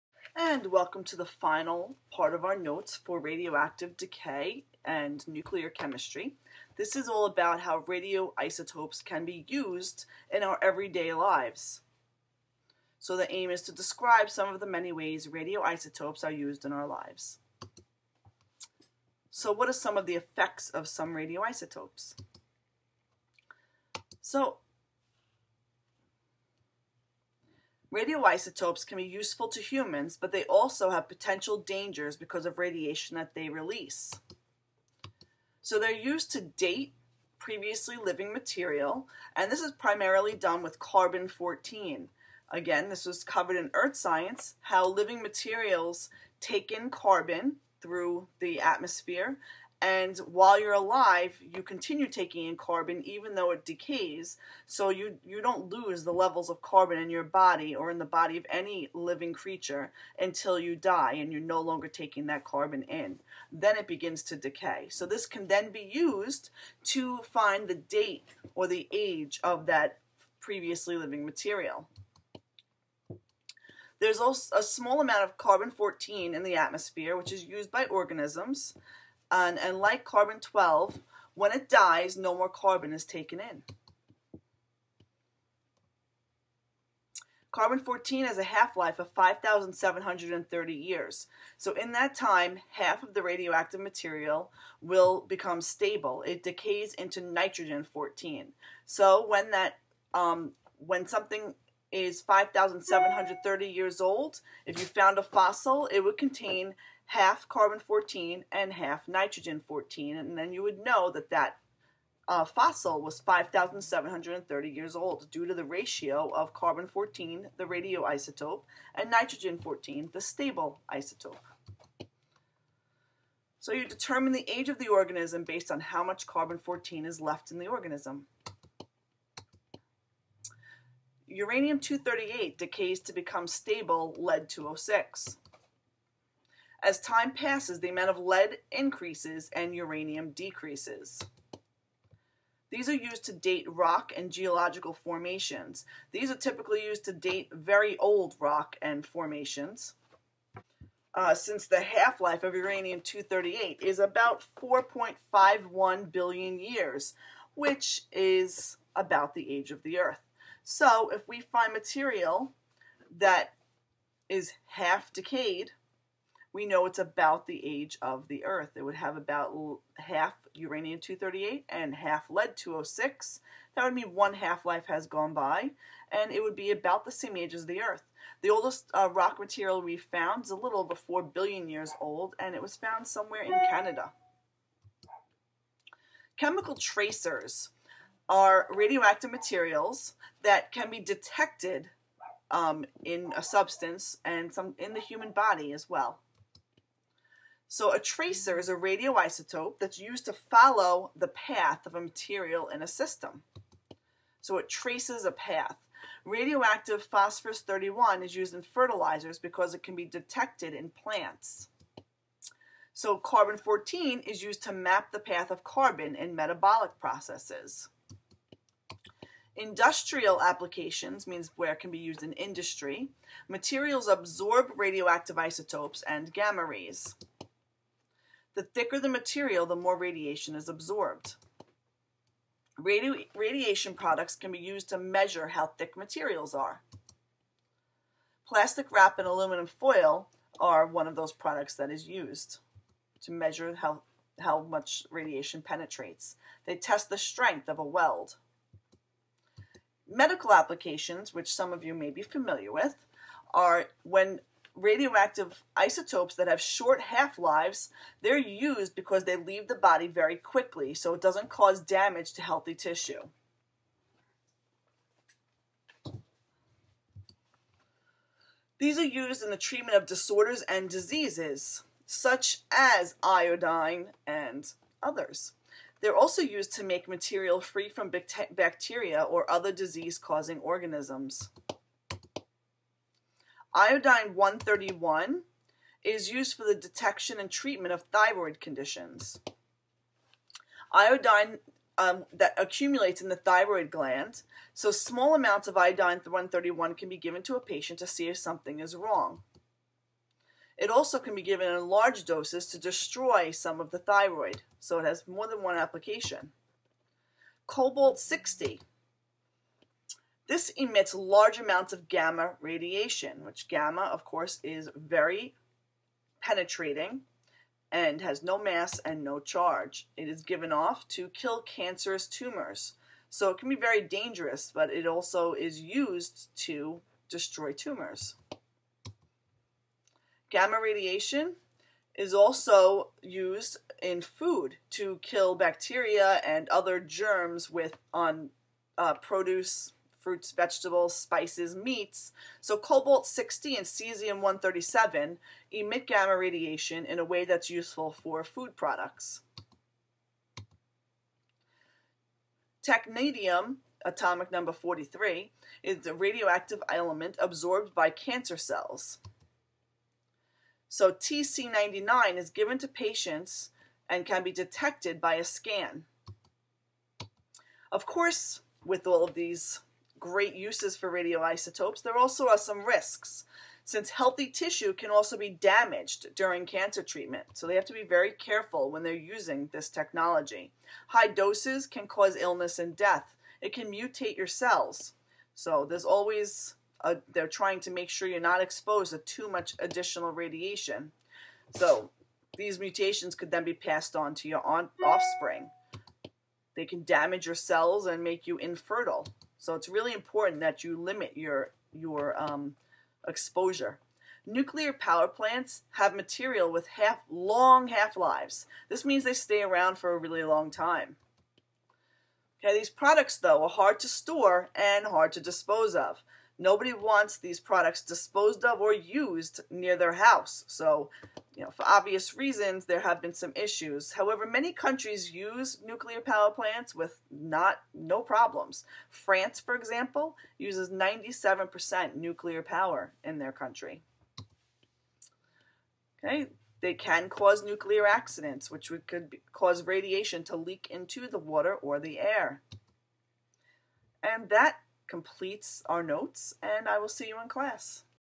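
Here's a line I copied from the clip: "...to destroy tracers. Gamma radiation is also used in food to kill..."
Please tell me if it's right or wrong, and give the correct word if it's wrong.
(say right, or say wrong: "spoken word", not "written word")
wrong: "tumors", not "tracers".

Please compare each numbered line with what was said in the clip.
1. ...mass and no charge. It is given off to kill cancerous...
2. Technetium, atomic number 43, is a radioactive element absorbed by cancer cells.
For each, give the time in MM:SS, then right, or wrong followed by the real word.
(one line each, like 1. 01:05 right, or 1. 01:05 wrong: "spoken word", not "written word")
1. 05:18 right
2. 05:52 right.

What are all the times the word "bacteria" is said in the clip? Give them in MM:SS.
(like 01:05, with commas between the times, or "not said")
04:38, 05:35.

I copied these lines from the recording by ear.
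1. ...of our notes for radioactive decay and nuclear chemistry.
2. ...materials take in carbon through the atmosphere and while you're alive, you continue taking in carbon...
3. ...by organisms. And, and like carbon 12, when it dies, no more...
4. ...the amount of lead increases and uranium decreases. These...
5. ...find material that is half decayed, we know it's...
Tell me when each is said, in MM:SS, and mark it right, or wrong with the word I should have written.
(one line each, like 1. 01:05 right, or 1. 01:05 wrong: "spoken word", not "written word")
1. 00:02 right
2. 00:45 right
3. 01:17 right
4. 02:17 right
5. 02:41 right.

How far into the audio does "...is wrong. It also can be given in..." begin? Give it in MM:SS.
04:58.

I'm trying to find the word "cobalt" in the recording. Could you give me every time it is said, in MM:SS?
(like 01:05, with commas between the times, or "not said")
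05:07, 05:42.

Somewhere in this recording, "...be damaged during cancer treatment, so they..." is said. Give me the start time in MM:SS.
06:15.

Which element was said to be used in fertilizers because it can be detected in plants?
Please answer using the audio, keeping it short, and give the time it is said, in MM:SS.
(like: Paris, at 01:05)
phosphorus 31, at 03:27.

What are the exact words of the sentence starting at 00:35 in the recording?
So they're used to date previously living material, and this is primarily done with carbon 14.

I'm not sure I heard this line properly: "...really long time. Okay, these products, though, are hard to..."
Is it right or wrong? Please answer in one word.
right.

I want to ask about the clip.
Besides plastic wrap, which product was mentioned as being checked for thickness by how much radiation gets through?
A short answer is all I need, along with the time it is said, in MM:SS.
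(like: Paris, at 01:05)
aluminum foil, at 03:59.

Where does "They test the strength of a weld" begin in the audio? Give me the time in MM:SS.
04:06.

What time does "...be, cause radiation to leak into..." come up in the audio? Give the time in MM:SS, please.
07:19.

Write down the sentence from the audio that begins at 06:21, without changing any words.
High doses can cause illness and death.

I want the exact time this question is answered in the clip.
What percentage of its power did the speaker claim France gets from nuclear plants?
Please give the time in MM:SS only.
07:10.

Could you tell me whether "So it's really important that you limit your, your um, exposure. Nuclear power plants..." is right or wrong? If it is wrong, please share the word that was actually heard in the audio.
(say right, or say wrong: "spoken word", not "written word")
right.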